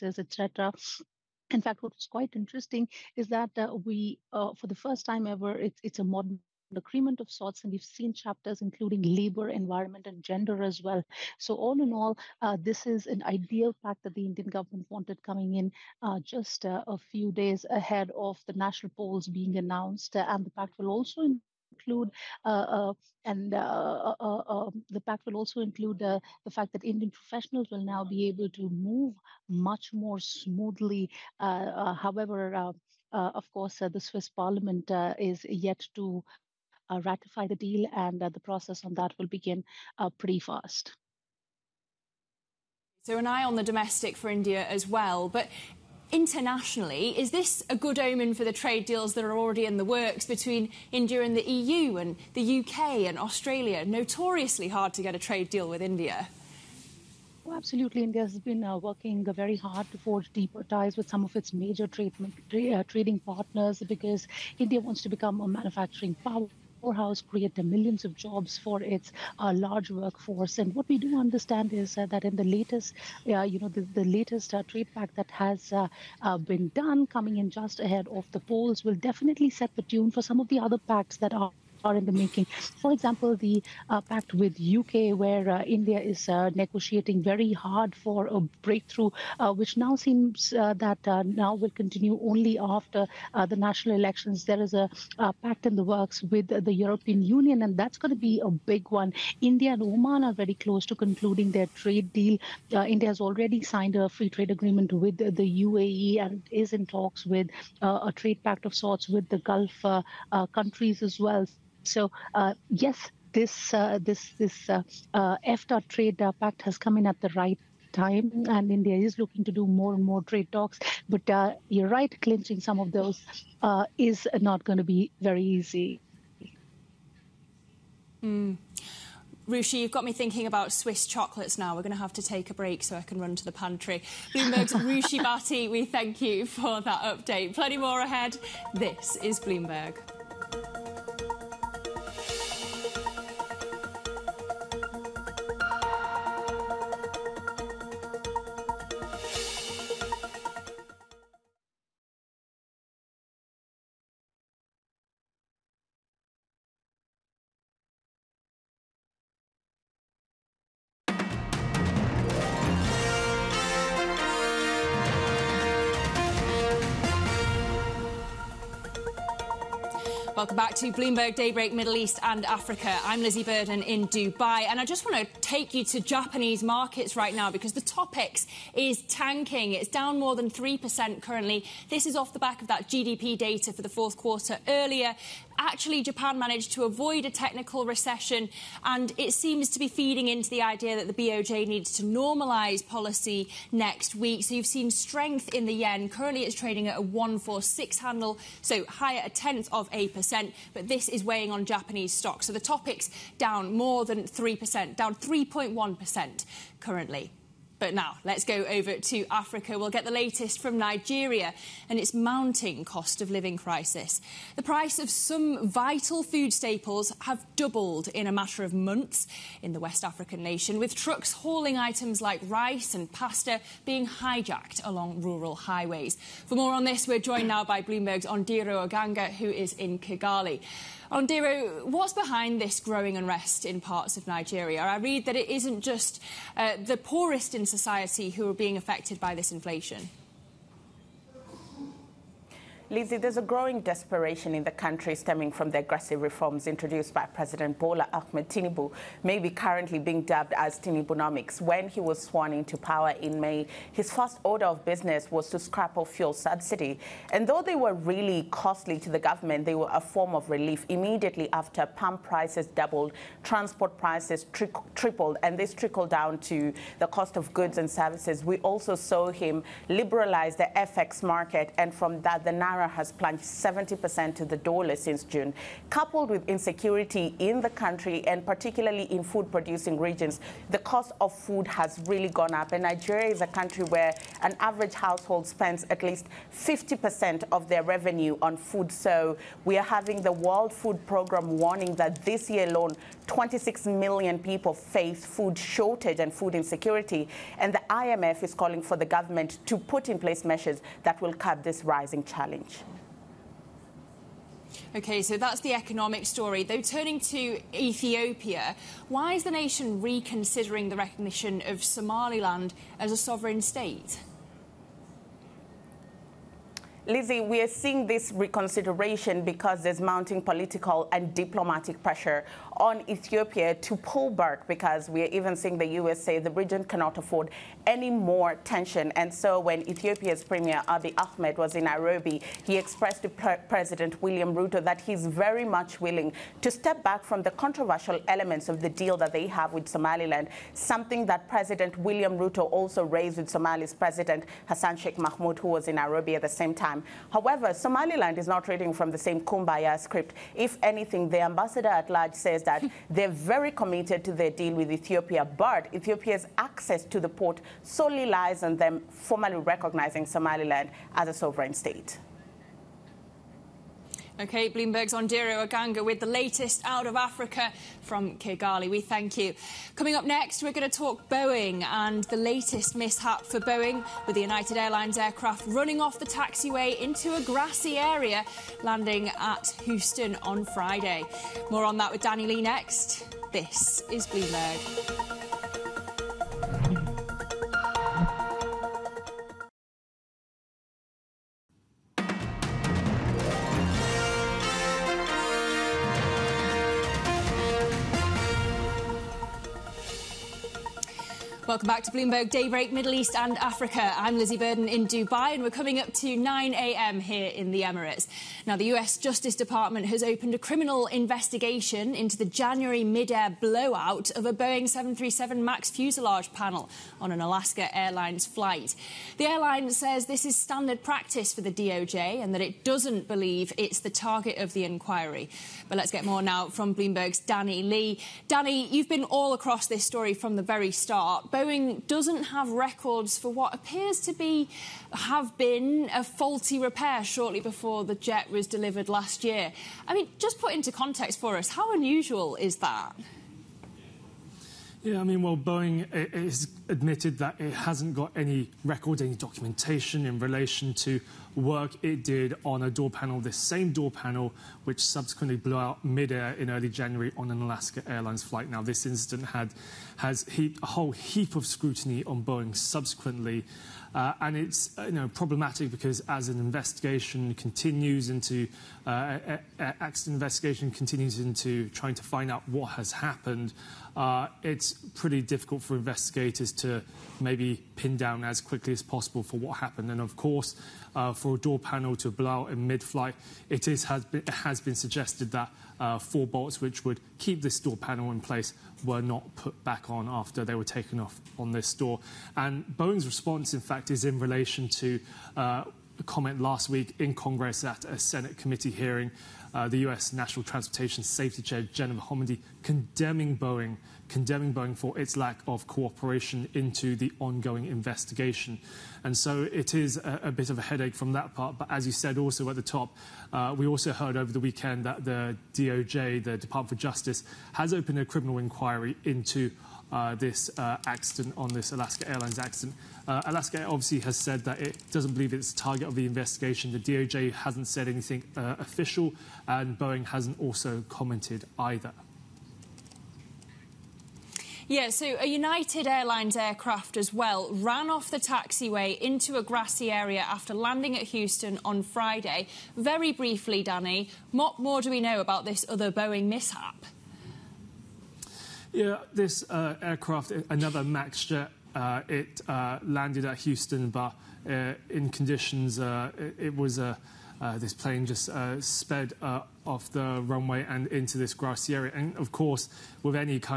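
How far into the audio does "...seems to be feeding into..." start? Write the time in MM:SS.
03:09.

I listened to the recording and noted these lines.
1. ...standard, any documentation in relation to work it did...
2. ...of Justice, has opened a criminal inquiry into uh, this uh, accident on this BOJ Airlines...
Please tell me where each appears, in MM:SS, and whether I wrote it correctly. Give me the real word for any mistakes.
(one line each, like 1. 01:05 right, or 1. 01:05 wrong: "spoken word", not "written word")
1. 07:28 wrong: "record", not "standard"
2. 08:36 wrong: "Alaska", not "BOJ".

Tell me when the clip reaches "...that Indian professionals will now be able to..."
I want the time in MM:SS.
00:26.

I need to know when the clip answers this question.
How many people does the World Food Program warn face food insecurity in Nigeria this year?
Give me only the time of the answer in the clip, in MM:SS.
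04:53.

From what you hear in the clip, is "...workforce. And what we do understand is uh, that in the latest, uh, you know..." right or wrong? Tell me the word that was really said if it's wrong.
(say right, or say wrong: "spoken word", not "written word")
right.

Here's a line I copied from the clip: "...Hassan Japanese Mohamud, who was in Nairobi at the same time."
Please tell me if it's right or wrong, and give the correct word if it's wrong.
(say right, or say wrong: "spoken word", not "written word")
wrong: "Sheikh", not "Japanese".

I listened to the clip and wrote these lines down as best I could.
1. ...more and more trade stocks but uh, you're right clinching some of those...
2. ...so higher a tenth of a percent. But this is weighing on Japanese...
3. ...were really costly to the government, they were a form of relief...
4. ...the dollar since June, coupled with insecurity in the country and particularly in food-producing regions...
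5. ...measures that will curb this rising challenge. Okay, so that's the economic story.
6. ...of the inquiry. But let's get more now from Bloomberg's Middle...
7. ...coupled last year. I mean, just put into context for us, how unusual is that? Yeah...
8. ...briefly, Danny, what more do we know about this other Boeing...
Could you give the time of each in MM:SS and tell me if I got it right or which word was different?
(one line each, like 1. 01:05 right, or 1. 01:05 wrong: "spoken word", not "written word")
1. 01:59 wrong: "talks", not "stocks"
2. 03:18 right
3. 04:17 right
4. 04:34 right
5. 05:00 right
6. 07:04 wrong: "Danny", not "Middle"
7. 07:18 wrong: "delivered", not "coupled"
8. 09:03 right.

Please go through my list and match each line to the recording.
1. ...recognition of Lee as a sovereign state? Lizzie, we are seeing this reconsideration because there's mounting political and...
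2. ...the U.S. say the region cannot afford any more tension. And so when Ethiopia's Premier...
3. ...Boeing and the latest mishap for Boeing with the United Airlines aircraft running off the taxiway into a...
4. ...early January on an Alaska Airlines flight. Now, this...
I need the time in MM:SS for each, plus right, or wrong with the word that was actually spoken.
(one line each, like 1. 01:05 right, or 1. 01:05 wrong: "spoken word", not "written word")
1. 05:10 wrong: "Somaliland", not "Lee"
2. 05:25 right
3. 06:11 right
4. 07:36 right.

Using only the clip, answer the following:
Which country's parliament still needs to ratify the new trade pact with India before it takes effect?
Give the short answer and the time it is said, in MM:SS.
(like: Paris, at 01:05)
Swiss Parliament, at 00:33.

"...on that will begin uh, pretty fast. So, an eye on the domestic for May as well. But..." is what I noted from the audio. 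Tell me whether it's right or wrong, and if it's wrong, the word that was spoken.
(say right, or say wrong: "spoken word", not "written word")
wrong: "India", not "May".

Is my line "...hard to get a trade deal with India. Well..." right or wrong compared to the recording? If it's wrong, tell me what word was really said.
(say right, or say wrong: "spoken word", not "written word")
right.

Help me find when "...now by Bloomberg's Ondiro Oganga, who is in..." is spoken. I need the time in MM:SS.
03:47.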